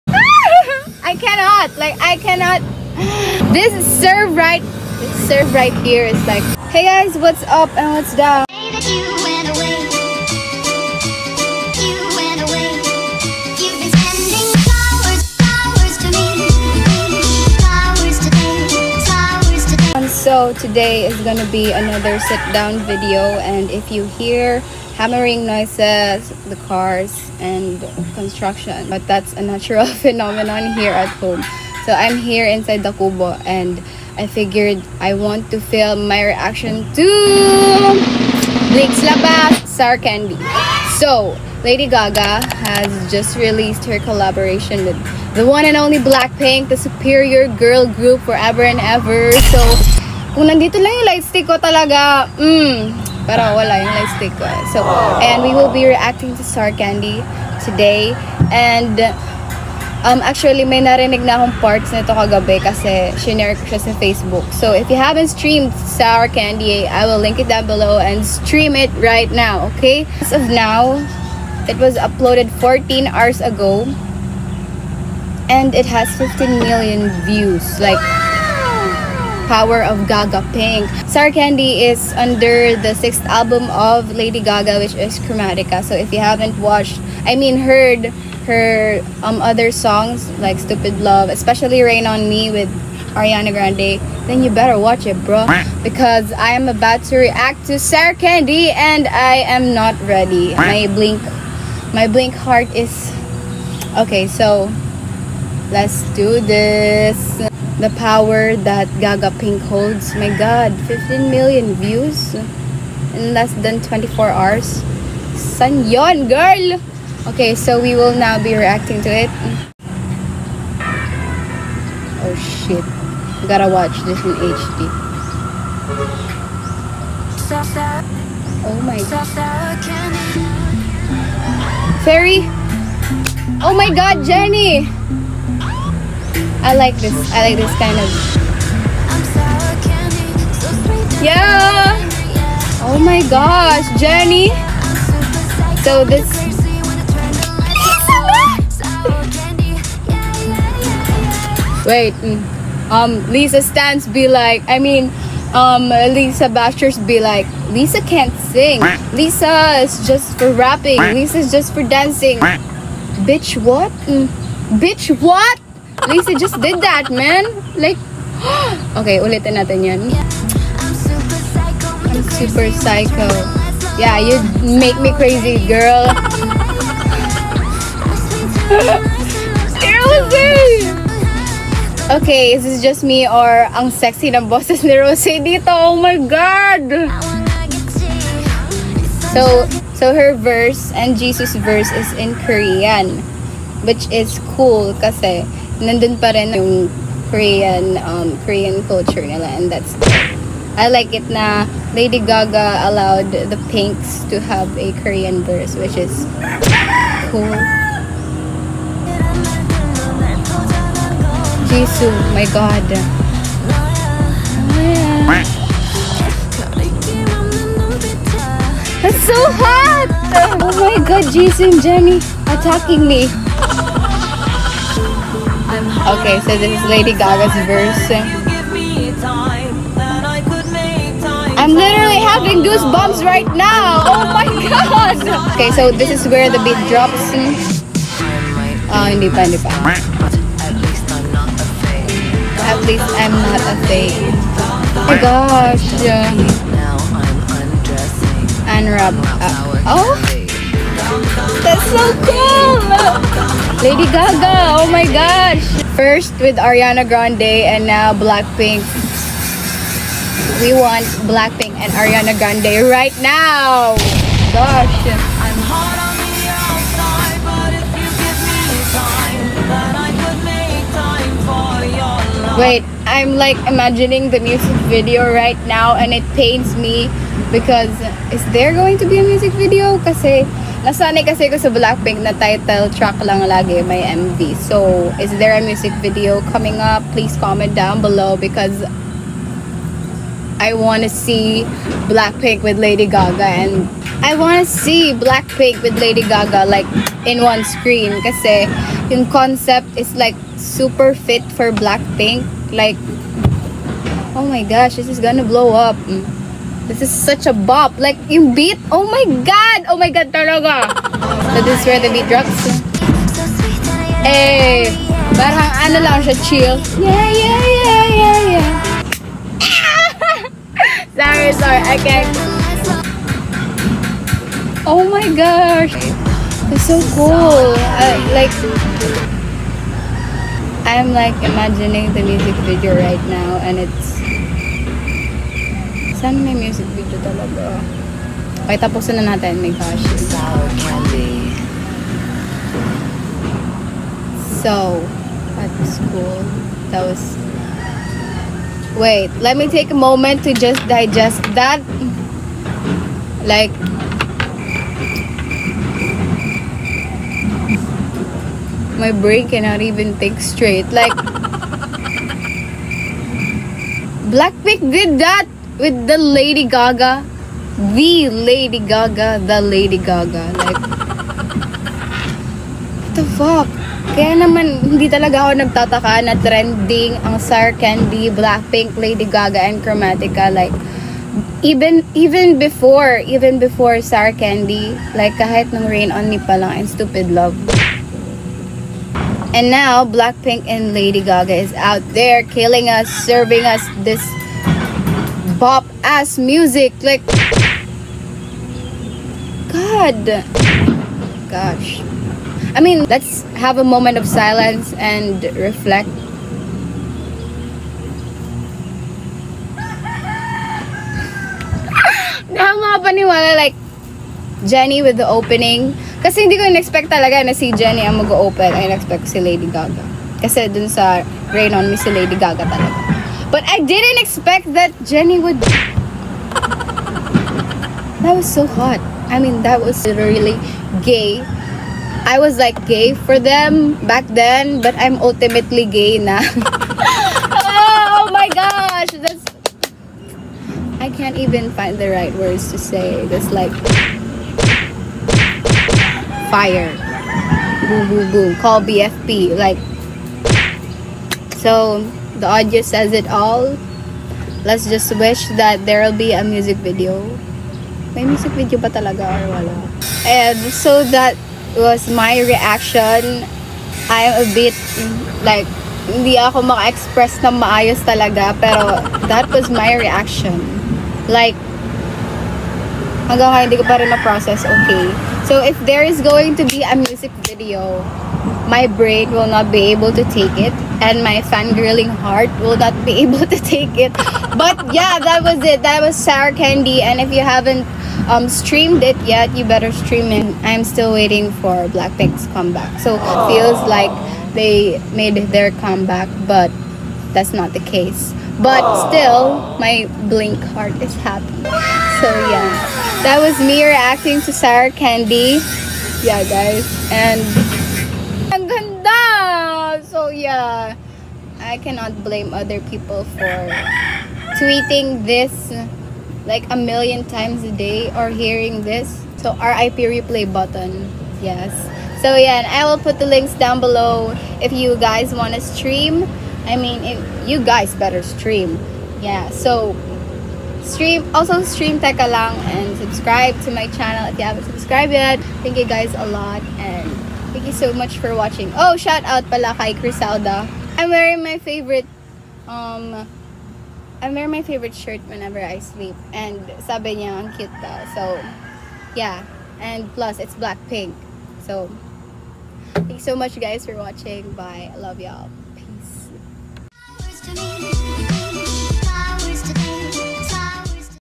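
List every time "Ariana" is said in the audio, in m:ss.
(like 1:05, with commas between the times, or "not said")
1:33, 4:16, 4:21.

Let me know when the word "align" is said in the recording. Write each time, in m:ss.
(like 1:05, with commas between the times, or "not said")
not said.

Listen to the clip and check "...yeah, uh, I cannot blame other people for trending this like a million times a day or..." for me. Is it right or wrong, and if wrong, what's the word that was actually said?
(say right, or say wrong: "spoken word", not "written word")
wrong: "tweeting", not "trending".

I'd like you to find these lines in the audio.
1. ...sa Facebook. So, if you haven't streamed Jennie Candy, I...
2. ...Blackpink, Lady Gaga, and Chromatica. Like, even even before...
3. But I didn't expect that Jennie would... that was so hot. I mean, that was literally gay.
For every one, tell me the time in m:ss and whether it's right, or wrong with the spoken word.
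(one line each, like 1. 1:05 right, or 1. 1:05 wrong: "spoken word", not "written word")
1. 1:03 wrong: "Sour", not "Jennie"
2. 6:18 right
3. 7:03 right.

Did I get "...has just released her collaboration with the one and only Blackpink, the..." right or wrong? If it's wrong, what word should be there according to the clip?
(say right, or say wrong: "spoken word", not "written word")
right.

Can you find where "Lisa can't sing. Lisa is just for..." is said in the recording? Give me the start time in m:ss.
2:37.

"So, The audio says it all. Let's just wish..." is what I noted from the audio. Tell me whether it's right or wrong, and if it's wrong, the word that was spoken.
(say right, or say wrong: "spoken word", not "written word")
right.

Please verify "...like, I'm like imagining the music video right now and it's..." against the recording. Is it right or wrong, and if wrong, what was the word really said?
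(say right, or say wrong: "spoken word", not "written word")
right.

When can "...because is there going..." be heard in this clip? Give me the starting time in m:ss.
4:37.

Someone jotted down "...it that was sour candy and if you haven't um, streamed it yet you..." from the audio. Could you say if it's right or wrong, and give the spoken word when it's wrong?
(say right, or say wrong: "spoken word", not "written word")
right.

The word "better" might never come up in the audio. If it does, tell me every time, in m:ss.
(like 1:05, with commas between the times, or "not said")
1:34, 8:09, 8:47.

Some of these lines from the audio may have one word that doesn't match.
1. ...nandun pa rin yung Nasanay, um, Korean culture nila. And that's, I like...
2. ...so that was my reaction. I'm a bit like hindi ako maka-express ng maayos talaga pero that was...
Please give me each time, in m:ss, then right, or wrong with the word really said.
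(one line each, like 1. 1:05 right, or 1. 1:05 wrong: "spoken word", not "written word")
1. 3:15 wrong: "Korean", not "Nasanay"
2. 7:40 right.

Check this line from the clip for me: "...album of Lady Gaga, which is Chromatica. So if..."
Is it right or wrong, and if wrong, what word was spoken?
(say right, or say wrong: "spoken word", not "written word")
right.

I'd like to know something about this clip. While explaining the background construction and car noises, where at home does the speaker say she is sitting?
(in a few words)
Kubo.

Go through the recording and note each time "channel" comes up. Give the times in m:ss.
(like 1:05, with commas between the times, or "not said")
8:53.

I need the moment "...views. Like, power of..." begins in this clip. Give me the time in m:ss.
1:17.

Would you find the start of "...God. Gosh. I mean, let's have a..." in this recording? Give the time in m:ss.
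6:39.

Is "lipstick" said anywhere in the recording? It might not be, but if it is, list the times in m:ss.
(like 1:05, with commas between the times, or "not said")
0:54.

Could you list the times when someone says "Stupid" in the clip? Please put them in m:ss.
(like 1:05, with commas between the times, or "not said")
1:30, 6:26.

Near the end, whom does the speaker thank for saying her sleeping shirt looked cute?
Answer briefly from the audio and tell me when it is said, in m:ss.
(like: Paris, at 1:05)
Crisalda, at 8:59.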